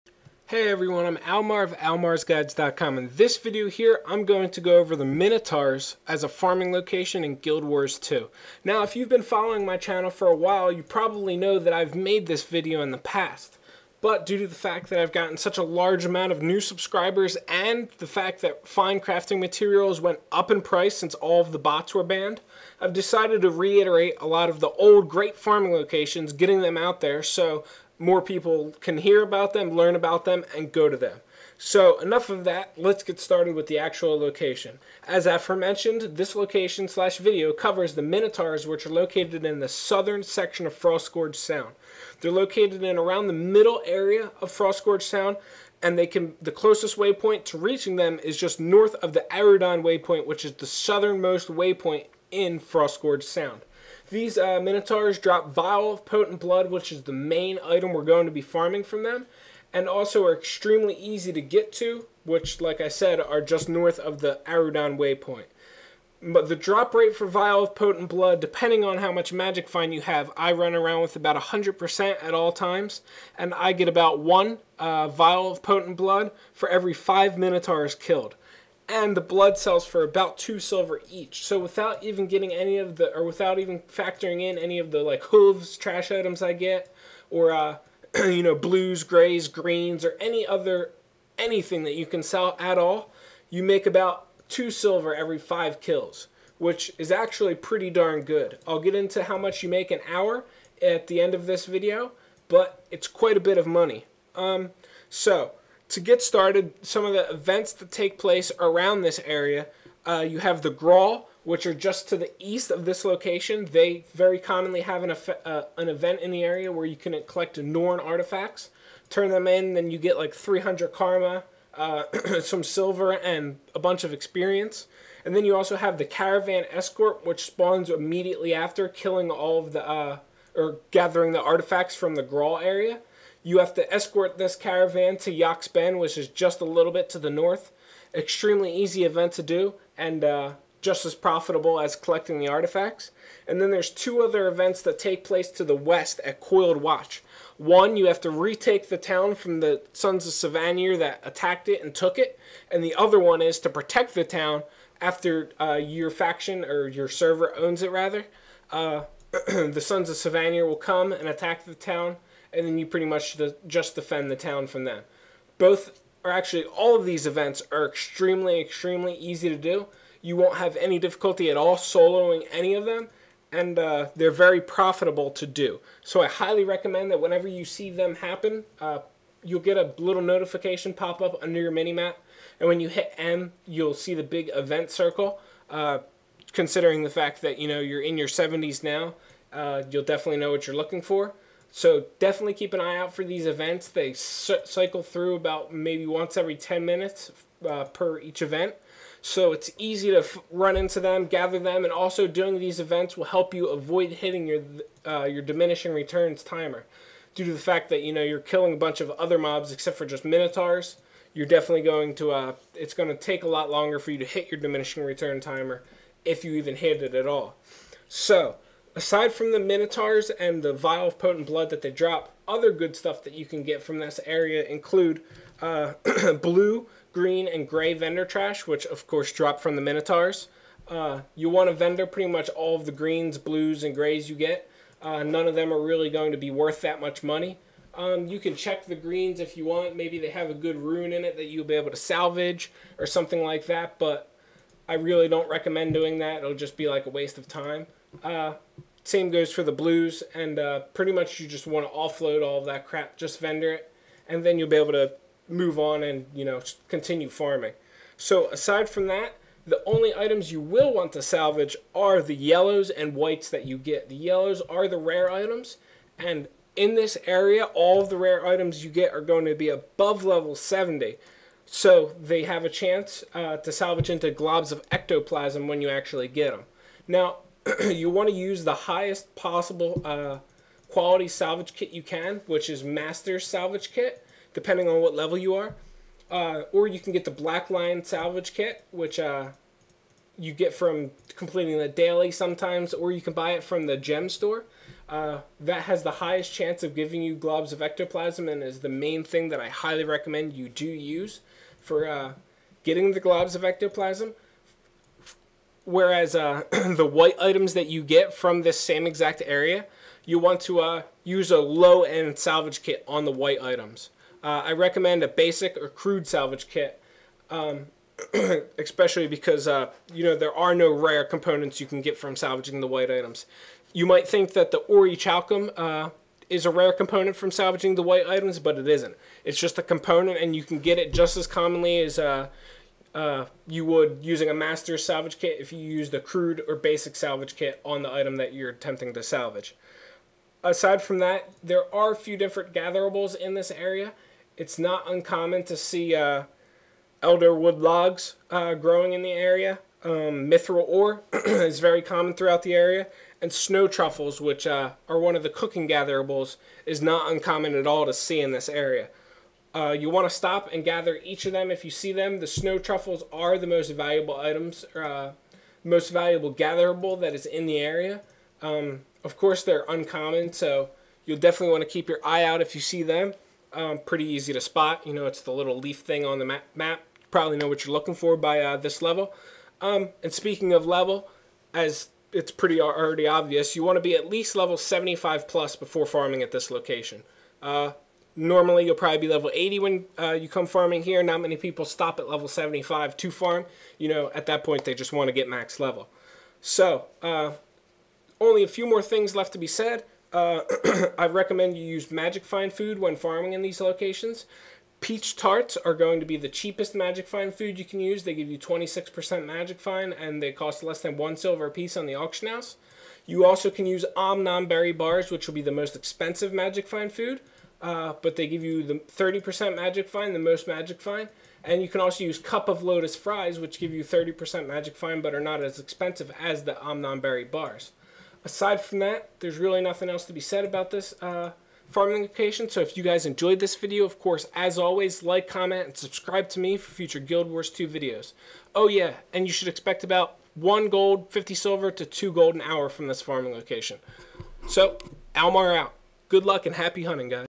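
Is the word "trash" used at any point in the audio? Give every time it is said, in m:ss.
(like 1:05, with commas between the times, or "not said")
1:25, 3:48.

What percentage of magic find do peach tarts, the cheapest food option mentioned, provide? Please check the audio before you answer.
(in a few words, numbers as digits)
26%.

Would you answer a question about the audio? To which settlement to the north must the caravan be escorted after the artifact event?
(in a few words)
Yaks Bend.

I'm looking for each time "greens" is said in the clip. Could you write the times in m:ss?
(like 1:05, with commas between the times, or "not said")
1:29, 3:47, 3:52, 3:58.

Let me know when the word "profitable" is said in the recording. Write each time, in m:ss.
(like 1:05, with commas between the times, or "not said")
2:21, 2:54.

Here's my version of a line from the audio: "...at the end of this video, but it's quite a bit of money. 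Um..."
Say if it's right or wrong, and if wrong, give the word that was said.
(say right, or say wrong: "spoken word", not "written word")
right.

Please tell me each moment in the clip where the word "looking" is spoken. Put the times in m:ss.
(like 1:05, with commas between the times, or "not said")
3:10, 6:17.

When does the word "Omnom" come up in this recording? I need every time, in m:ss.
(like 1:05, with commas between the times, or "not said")
6:54, 7:06.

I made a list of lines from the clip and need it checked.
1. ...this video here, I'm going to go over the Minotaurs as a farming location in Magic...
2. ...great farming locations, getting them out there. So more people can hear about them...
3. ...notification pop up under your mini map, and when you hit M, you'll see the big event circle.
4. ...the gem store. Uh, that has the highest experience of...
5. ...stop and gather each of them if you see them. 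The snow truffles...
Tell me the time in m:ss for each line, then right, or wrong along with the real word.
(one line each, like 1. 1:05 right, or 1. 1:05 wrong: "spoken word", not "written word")
1. 0:03 wrong: "Guild", not "Magic"
2. 0:25 right
3. 3:00 right
4. 4:53 wrong: "chance", not "experience"
5. 6:00 right.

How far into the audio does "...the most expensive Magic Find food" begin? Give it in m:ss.
6:55.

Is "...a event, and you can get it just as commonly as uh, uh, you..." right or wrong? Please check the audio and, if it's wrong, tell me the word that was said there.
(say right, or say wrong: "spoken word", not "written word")
wrong: "component", not "event".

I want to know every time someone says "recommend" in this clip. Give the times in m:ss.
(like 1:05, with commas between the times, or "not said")
2:56, 4:05, 5:00, 5:14, 6:41.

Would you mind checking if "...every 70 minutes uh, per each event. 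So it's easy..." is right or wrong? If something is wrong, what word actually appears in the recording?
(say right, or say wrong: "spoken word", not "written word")
wrong: "10", not "70".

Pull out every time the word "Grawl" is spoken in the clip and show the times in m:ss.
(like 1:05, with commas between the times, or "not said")
1:50, 2:12.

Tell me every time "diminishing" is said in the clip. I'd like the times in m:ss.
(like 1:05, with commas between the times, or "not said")
3:25, 3:34.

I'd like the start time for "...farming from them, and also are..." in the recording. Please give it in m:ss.
0:58.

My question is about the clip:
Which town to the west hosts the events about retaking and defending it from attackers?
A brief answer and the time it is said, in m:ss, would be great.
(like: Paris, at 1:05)
Coiled Watch, at 2:26.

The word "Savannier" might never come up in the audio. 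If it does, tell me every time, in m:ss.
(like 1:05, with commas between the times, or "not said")
2:30, 2:40.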